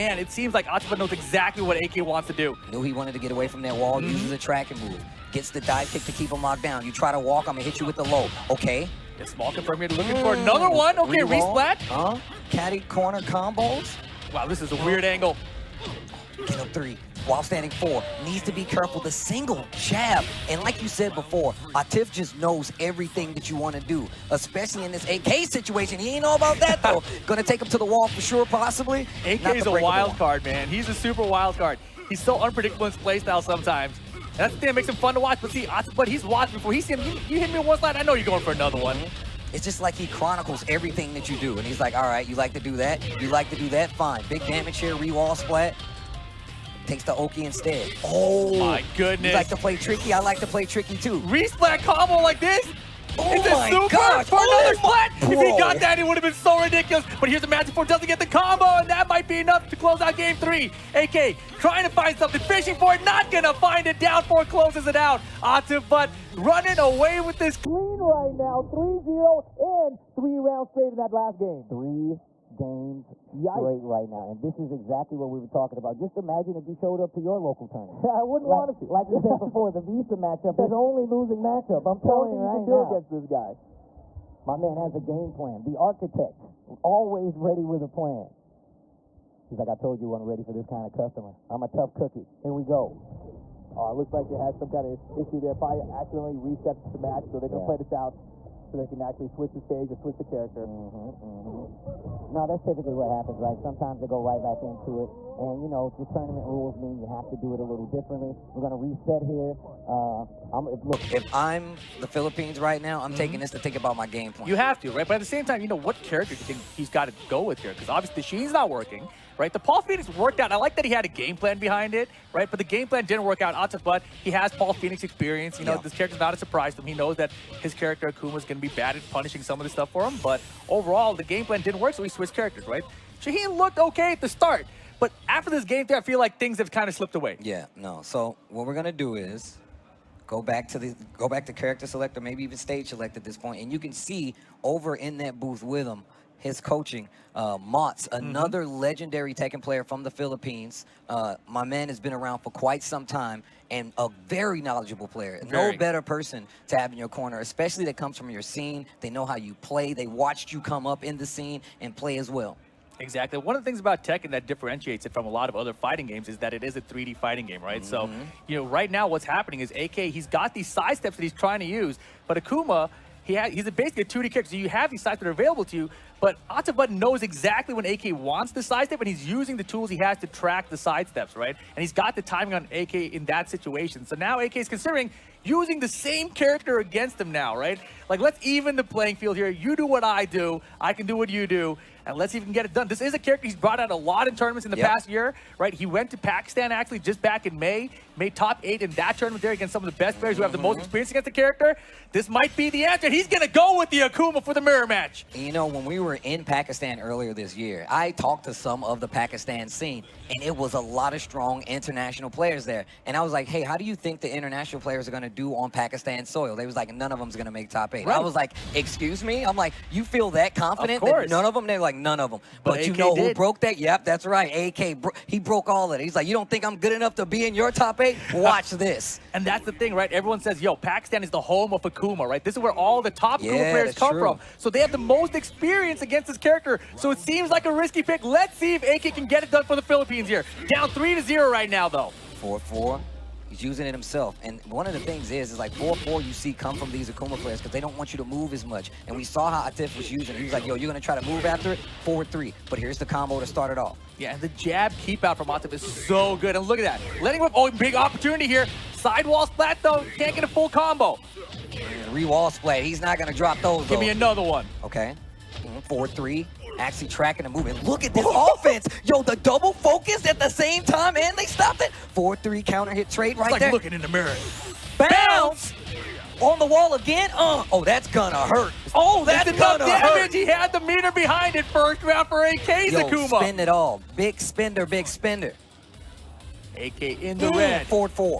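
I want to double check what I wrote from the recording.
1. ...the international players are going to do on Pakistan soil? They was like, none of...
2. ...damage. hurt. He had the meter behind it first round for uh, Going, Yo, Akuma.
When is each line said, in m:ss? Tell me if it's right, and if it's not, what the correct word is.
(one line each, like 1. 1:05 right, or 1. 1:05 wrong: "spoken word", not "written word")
1. 3:34 right
2. 4:39 wrong: "AKs", not "Going".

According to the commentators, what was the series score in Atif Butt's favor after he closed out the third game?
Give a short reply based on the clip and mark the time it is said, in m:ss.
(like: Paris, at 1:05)
3-0, at 1:08.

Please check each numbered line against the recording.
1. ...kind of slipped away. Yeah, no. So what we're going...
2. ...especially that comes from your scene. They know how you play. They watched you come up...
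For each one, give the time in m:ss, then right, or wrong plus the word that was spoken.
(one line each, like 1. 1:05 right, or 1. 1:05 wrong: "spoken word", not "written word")
1. 2:16 right
2. 2:37 right.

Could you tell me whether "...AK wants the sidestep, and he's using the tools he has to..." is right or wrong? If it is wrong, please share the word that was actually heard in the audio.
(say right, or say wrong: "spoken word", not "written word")
right.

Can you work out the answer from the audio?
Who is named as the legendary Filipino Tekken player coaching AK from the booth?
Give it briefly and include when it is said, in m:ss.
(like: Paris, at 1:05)
Mots, at 2:27.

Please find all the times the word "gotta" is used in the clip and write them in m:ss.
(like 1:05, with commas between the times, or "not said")
not said.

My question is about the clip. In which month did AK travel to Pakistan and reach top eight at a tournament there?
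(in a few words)
May.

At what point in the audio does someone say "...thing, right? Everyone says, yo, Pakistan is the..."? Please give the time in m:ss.
3:49.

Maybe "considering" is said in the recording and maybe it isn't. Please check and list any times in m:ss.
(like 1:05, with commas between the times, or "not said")
3:04.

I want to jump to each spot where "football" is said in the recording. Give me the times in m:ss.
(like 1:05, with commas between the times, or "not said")
not said.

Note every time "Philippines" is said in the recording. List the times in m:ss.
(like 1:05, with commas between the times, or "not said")
1:52, 2:30, 3:59.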